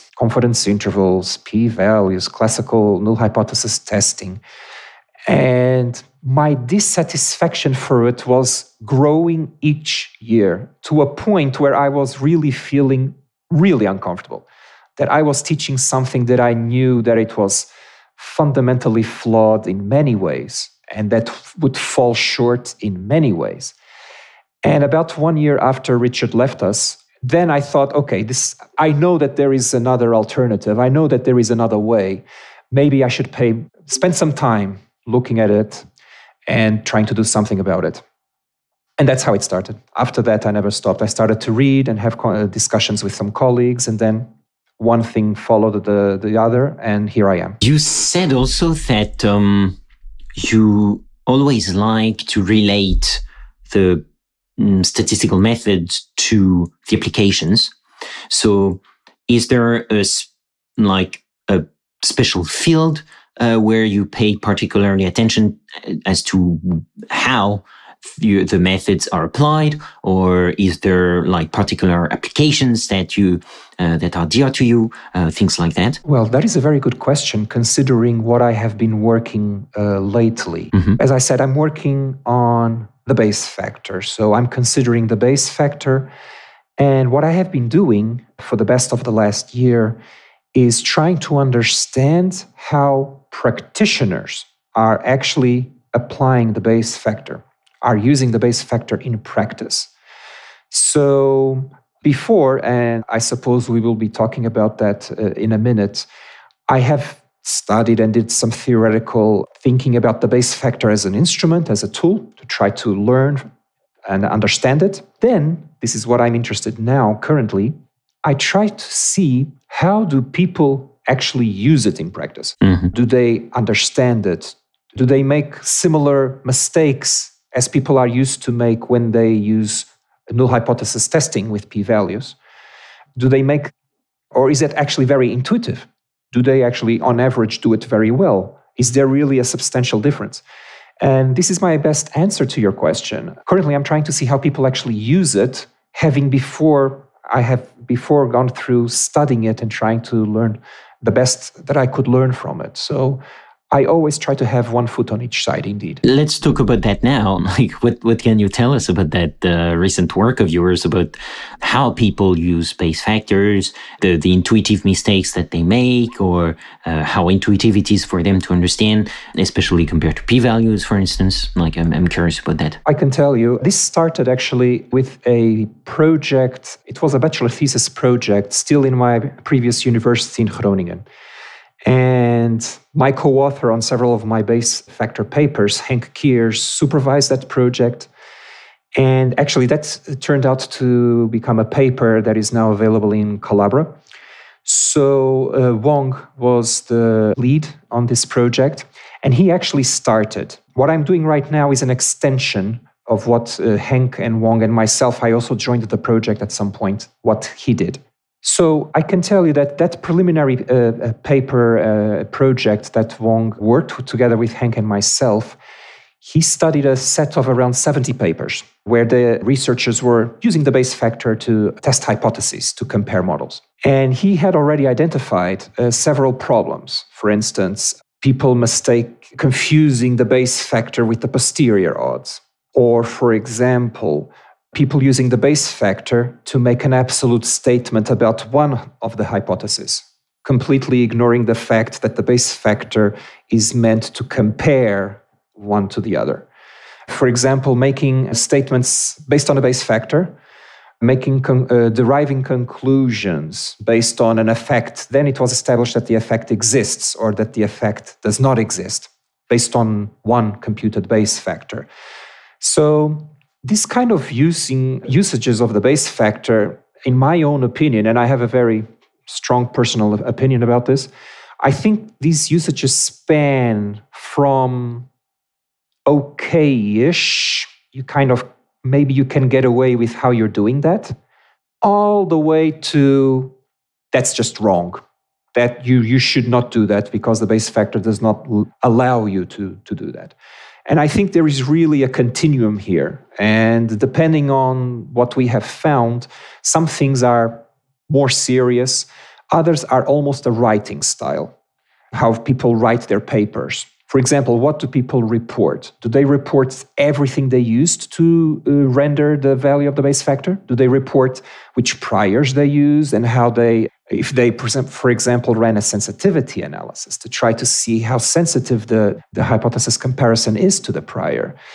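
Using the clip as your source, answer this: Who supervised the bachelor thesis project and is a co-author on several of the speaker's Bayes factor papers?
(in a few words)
Henk Kiers.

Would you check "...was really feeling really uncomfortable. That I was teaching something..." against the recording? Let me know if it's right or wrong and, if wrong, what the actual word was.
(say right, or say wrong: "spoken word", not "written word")
right.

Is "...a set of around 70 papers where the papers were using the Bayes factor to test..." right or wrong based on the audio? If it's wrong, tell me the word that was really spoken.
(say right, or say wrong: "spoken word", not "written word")
wrong: "researchers", not "papers".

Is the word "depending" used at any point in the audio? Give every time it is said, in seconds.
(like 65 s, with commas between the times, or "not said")
293 s.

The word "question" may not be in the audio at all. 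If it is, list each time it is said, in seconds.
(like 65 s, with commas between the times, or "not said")
76 s, 142 s.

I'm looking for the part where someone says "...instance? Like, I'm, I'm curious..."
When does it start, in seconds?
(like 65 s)
170 s.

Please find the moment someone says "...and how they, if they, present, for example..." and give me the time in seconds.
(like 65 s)
313 s.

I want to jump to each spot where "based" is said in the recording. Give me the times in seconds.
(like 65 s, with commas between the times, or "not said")
249 s, 253 s, 259 s.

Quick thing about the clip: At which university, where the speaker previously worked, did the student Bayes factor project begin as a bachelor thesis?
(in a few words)
Groningen.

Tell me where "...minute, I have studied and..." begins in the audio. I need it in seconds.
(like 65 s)
105 s.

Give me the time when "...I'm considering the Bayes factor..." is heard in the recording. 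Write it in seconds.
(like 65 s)
84 s.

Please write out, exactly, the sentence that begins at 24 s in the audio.
And about one year after Richard left us, then I thought, okay, this I know that there is another alternative.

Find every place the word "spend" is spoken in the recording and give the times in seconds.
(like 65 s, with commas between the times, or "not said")
33 s.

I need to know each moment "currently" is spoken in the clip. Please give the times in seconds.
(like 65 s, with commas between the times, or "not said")
117 s, 143 s.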